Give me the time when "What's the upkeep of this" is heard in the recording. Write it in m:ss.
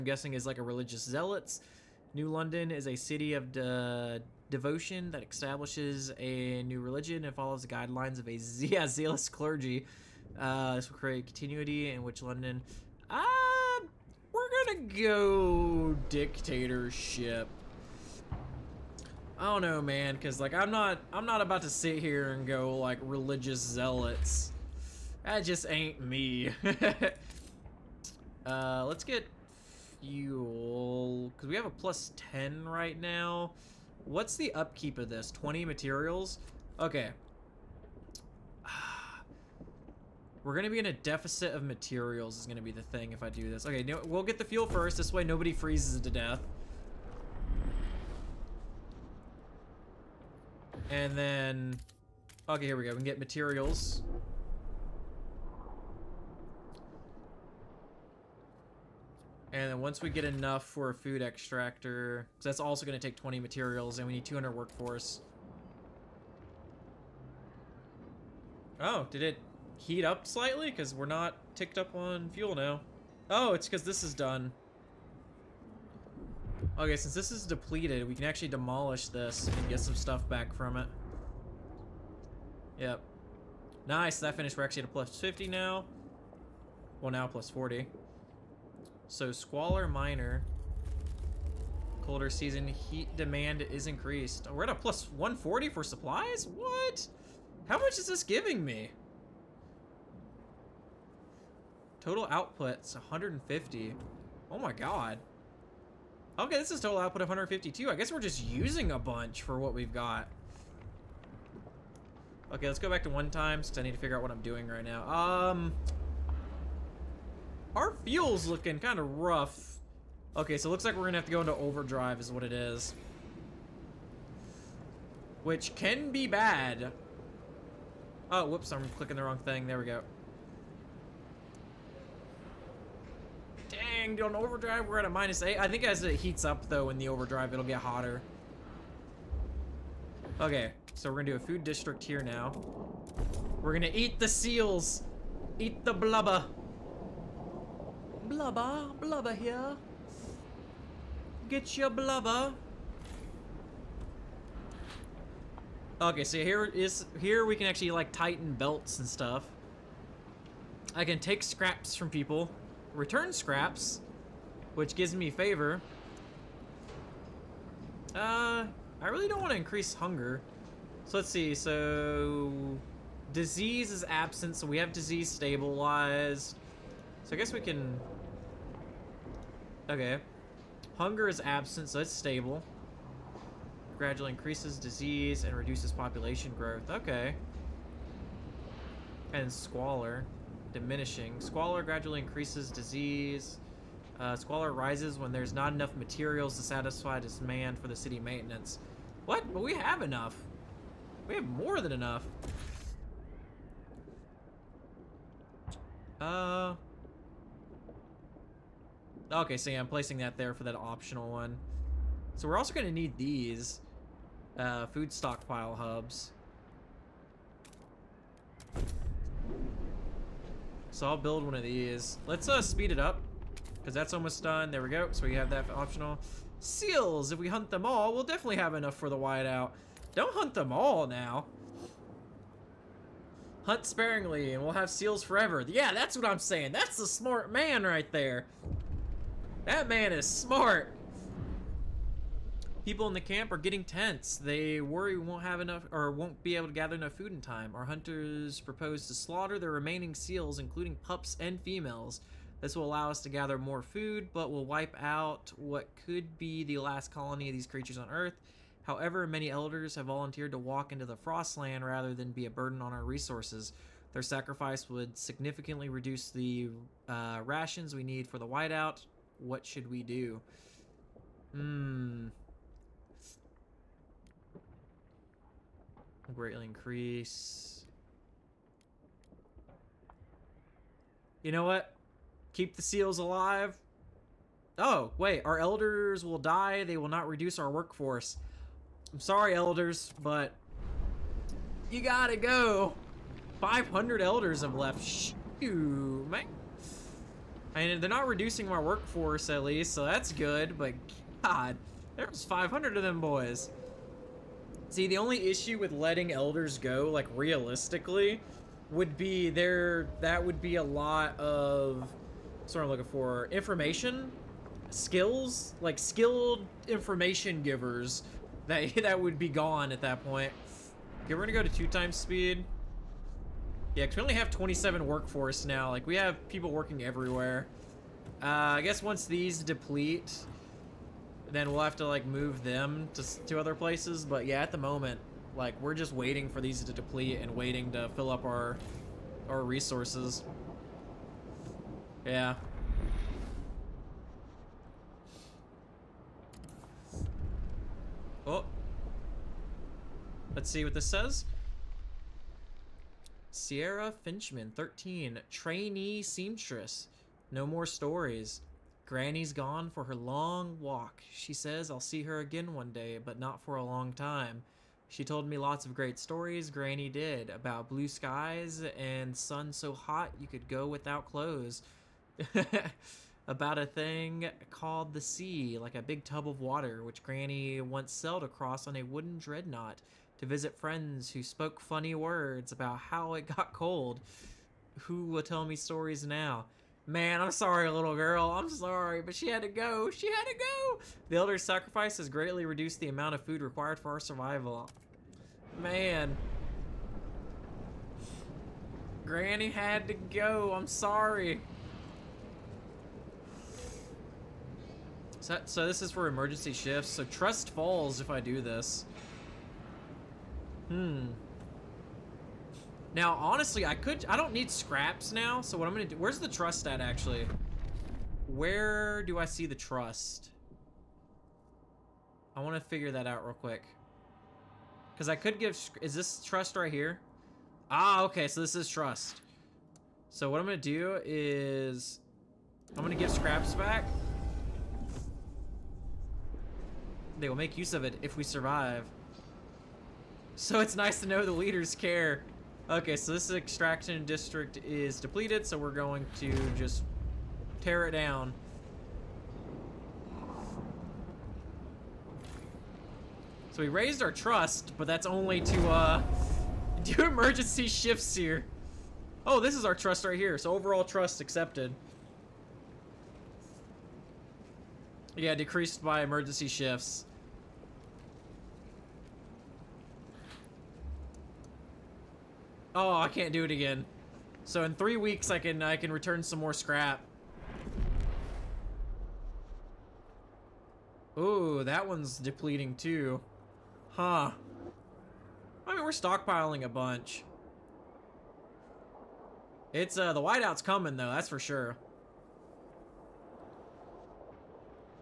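0:34.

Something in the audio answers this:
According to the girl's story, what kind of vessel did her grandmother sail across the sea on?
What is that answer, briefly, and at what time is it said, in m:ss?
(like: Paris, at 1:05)
A wooden dreadnought, at 6:19.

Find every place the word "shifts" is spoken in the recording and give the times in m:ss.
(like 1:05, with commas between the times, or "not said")
6:46, 7:37, 7:46.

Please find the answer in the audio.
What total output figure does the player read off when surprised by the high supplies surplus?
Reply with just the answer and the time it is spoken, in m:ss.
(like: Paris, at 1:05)
152, at 1:46.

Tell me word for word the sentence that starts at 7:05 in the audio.
Cause I could give, is this trust right here?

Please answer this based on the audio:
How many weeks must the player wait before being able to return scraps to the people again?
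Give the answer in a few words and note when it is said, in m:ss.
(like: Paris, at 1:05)
3, at 7:54.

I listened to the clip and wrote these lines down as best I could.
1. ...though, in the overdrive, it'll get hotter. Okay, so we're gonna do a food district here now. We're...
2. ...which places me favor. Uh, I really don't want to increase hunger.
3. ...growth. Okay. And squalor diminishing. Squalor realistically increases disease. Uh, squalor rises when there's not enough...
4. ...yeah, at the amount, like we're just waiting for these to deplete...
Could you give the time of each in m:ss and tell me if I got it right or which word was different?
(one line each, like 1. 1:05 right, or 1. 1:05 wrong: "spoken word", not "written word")
1. 2:16 right
2. 2:44 wrong: "gives", not "places"
3. 3:06 wrong: "gradually", not "realistically"
4. 5:34 wrong: "moment", not "amount".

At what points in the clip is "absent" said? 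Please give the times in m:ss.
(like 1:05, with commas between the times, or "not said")
2:54, 3:01.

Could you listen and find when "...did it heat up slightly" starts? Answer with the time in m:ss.
1:09.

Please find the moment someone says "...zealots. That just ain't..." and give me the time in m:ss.
0:23.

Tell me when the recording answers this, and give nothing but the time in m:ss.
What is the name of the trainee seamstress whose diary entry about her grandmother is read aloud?
5:53.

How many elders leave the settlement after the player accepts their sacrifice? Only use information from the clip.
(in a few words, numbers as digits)
500.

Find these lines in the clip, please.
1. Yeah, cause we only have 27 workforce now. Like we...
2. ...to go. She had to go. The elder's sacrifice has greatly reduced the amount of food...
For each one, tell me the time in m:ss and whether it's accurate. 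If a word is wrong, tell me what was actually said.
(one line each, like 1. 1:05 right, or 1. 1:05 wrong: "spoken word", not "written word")
1. 5:23 right
2. 6:29 right.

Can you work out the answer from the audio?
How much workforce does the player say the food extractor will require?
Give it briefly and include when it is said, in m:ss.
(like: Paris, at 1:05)
200, at 1:04.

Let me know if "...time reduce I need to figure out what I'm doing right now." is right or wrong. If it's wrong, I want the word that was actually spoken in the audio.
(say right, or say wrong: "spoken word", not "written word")
wrong: "since", not "reduce".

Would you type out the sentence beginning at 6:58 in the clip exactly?
Where do I see the trust?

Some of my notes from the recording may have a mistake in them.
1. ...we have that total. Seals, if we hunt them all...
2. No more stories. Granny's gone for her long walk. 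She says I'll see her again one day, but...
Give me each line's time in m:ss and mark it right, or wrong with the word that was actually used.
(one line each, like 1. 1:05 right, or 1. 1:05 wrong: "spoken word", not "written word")
1. 3:45 wrong: "optional", not "total"
2. 5:57 right.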